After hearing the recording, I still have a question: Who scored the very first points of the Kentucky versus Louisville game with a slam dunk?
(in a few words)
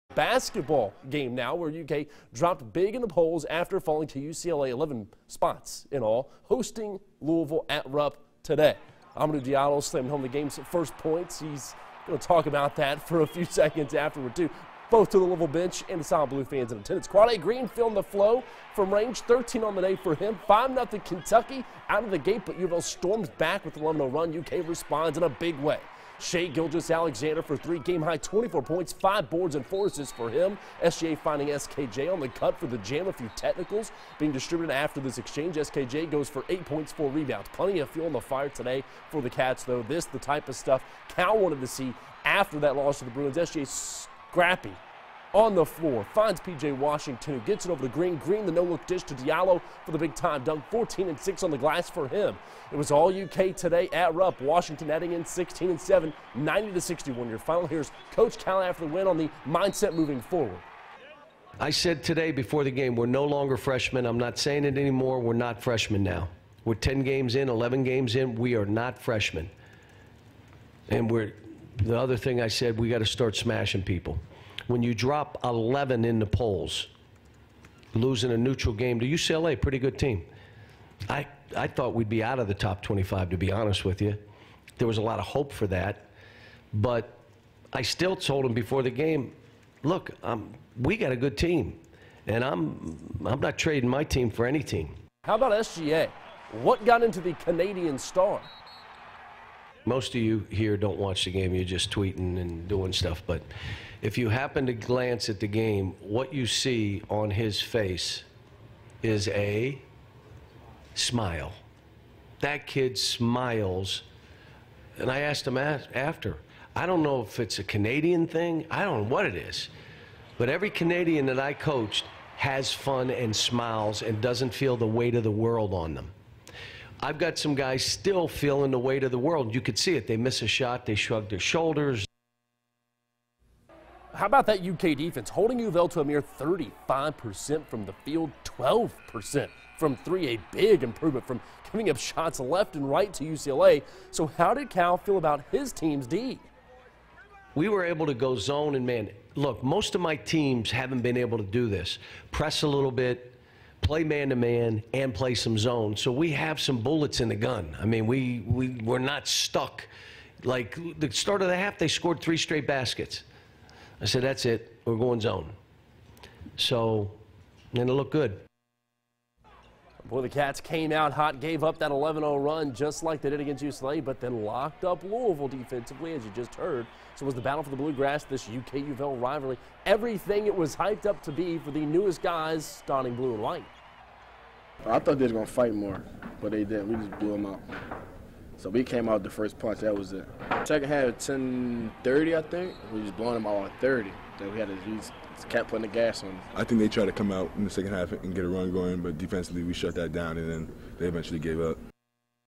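Hamidou Diallo.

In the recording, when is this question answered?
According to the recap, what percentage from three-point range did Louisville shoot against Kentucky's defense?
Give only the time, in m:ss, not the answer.
2:18.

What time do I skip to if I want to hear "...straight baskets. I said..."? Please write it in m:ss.
2:42.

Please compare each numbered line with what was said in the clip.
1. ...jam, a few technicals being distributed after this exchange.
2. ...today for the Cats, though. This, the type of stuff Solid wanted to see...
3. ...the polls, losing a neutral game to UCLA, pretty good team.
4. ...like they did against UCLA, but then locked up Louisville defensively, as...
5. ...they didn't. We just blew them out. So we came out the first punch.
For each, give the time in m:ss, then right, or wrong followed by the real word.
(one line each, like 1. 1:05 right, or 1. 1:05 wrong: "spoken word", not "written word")
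1. 0:32 right
2. 0:38 wrong: "Cal", not "Solid"
3. 1:16 right
4. 2:53 right
5. 3:06 right.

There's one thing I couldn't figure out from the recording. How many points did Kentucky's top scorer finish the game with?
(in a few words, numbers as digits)
24 points.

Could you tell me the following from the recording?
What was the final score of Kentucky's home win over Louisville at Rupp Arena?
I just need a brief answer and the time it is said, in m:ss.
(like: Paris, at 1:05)
90 to 61, at 0:56.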